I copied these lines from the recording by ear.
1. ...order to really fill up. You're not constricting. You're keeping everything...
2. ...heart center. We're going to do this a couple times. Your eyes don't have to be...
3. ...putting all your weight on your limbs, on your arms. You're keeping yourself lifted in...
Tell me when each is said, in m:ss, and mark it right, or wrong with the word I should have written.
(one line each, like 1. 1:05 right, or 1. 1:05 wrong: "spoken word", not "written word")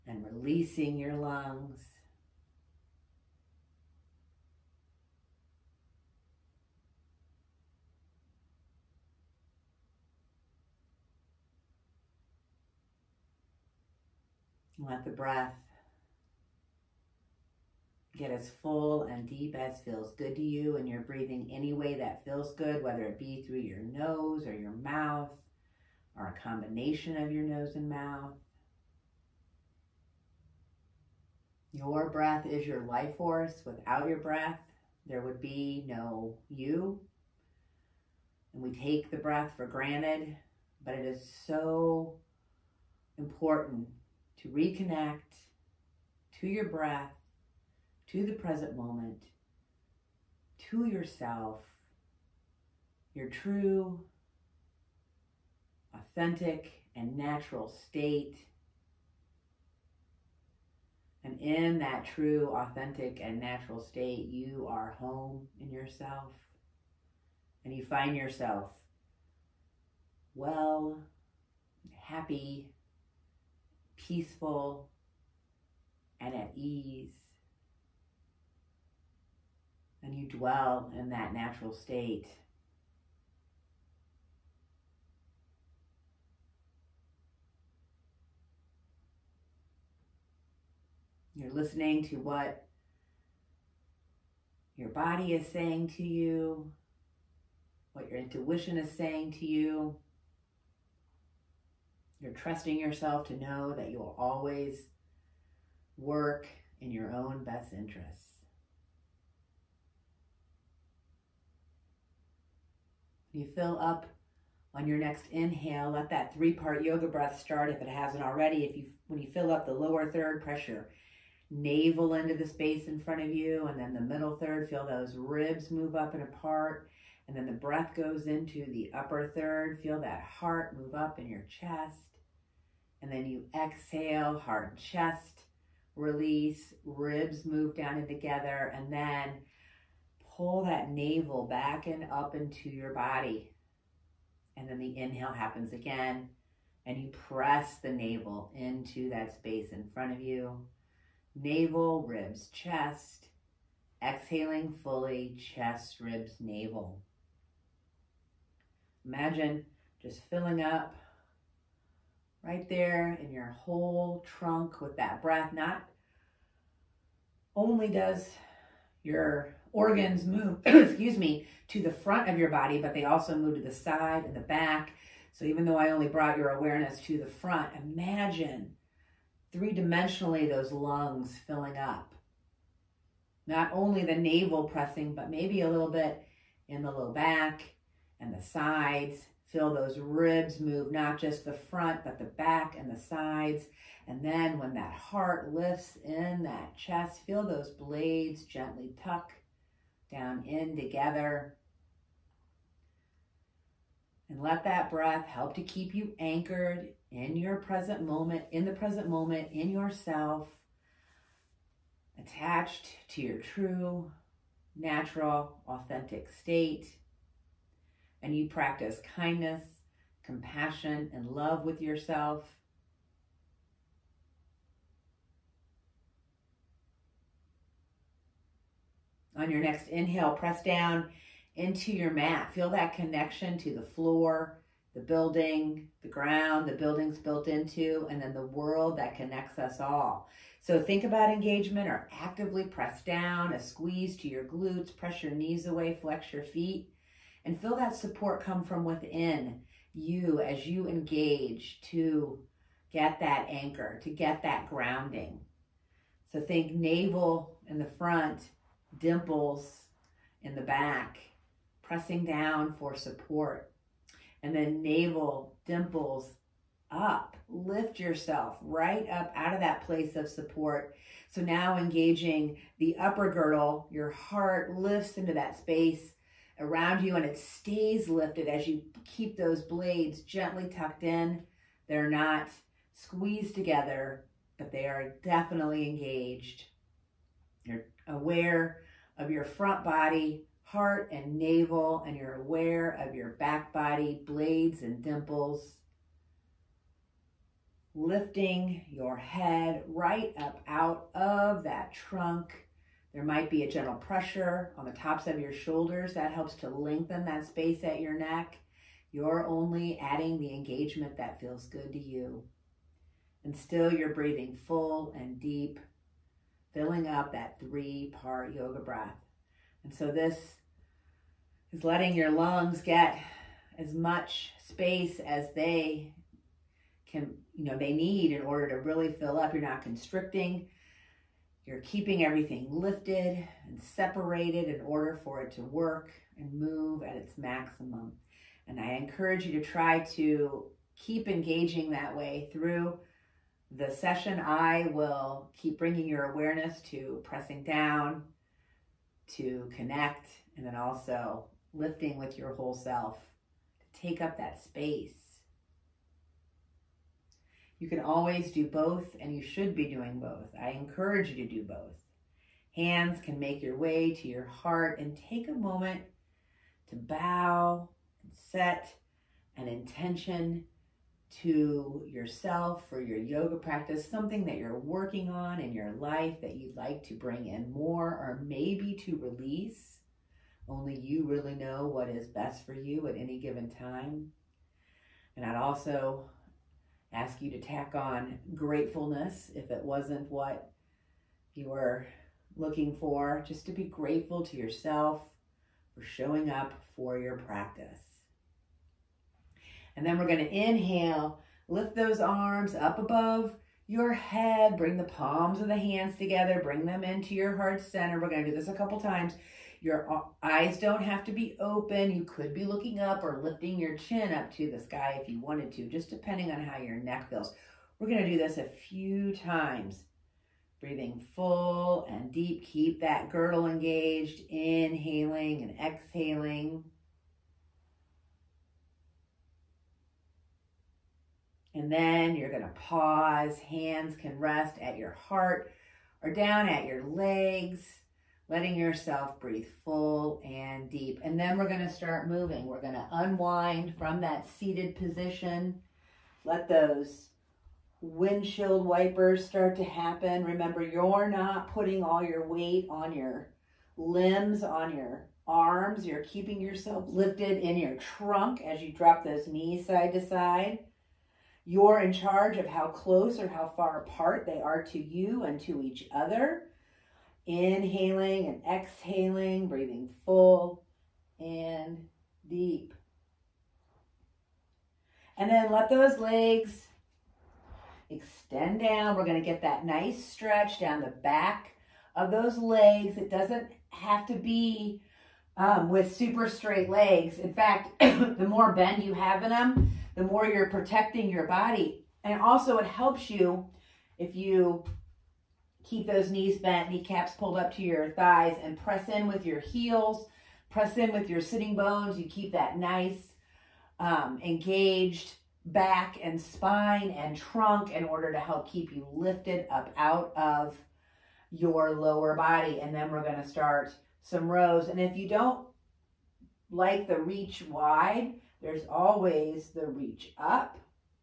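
1. 5:28 right
2. 6:47 right
3. 7:31 right.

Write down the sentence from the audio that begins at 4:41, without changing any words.
They're not squeezed together, but they are definitely engaged.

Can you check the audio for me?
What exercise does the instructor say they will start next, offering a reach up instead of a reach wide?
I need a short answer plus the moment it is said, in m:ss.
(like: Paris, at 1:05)
rows, at 8:34.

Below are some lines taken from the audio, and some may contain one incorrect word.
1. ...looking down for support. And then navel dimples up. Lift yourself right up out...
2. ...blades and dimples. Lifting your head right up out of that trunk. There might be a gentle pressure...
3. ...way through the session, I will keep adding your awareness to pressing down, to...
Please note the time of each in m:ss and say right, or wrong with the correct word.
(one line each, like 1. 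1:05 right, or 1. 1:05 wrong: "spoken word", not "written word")
1. 4:21 wrong: "pressing", not "looking"
2. 4:54 right
3. 5:42 wrong: "bringing", not "adding".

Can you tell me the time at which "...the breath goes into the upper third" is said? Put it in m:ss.
2:07.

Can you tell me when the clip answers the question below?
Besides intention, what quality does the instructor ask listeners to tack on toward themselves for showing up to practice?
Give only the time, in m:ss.
6:28.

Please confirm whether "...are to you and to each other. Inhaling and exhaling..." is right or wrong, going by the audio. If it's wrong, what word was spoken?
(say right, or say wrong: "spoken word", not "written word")
right.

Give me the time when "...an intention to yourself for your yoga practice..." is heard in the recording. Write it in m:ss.
6:09.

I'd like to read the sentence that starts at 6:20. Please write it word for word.
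Only you really know what is best for you at any given time.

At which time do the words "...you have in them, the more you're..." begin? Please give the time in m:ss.
8:09.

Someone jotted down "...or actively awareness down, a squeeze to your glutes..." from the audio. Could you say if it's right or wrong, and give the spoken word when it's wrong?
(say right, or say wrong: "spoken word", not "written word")
wrong: "press", not "awareness".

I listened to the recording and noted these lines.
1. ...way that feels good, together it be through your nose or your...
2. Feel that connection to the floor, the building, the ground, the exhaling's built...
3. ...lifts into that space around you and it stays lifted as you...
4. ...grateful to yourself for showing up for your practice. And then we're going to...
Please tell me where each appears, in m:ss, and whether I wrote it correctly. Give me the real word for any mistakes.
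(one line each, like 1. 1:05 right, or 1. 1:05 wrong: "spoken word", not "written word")
1. 0:21 wrong: "whether", not "together"
2. 3:52 wrong: "building", not "exhaling"
3. 4:34 right
4. 6:33 right.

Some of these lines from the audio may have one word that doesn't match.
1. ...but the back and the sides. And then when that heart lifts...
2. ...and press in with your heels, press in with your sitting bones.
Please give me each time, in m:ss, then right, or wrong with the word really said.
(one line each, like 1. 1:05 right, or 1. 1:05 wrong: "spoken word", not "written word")
1. 3:12 right
2. 8:18 right.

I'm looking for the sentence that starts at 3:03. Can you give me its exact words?
Not only the navel pressing, but maybe a little bit in the low back and the sides.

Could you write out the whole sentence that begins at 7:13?
Hands can rest at your heart or down at your legs, letting yourself breathe full and deep.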